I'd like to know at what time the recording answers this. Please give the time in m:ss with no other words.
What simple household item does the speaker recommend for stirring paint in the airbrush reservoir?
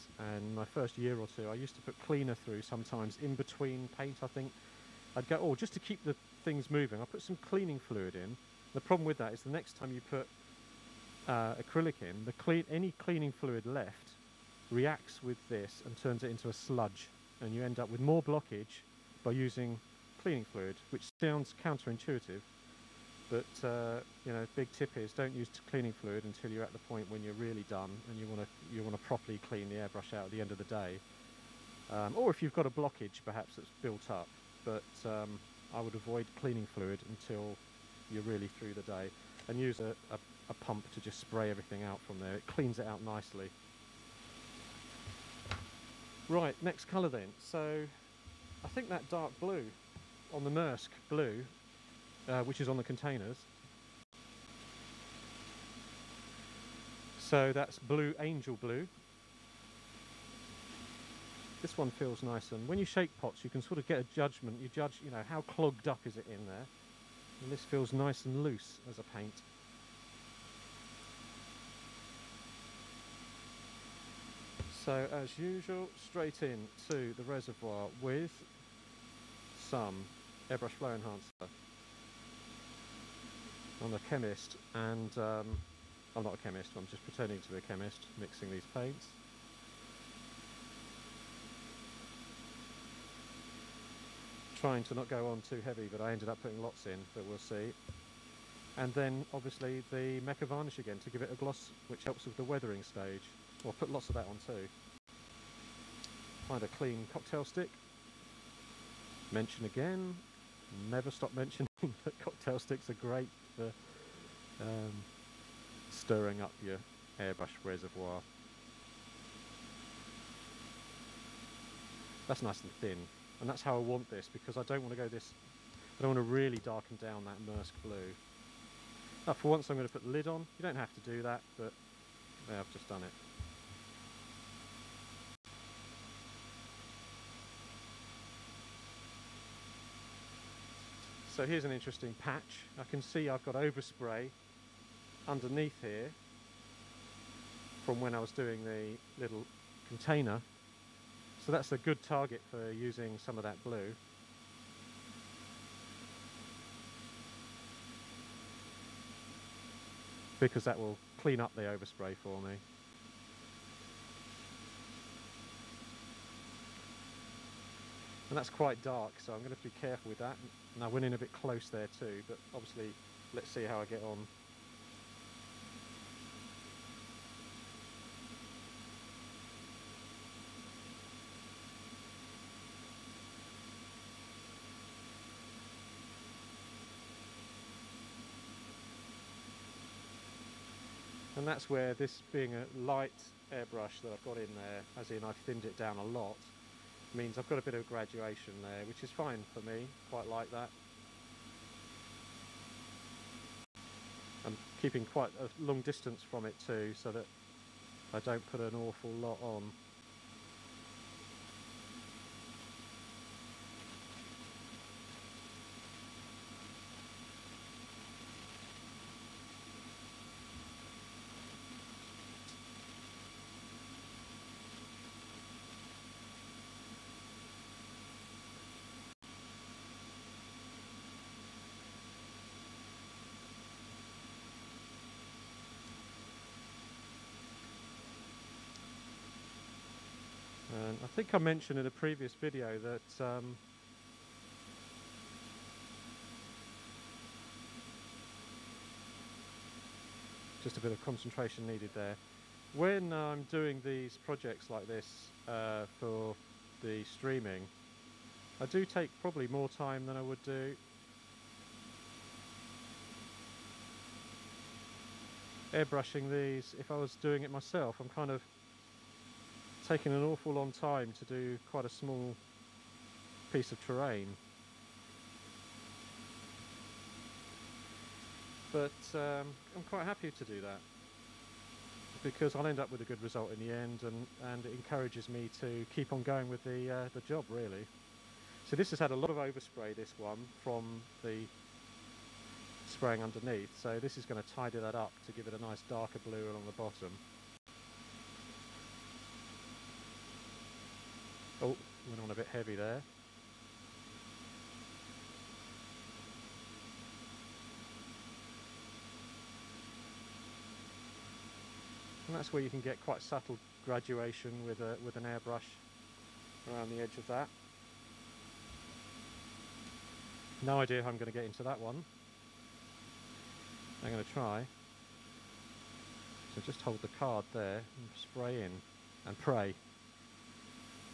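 1:52.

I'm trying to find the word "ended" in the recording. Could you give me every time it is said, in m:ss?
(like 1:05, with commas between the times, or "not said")
1:36.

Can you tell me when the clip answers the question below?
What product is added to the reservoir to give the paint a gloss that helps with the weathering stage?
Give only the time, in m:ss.
1:40.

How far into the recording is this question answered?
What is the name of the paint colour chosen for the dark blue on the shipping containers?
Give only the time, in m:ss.
0:57.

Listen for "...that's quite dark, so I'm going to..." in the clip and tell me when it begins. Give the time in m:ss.
2:48.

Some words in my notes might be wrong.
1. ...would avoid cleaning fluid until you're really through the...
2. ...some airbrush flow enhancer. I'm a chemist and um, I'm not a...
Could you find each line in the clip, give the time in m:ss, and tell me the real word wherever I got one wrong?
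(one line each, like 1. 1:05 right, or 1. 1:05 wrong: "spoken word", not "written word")
1. 0:35 right
2. 1:19 right.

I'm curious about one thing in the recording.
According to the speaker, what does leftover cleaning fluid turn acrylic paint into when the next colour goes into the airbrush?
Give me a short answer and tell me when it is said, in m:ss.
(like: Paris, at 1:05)
sludge, at 0:16.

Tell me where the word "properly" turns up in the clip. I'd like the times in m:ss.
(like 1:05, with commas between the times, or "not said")
0:29.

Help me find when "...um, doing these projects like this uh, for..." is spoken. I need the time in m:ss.
4:13.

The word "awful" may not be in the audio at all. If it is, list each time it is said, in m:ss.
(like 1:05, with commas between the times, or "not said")
3:28, 4:30.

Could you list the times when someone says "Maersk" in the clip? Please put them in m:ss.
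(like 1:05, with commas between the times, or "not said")
0:50, 2:07.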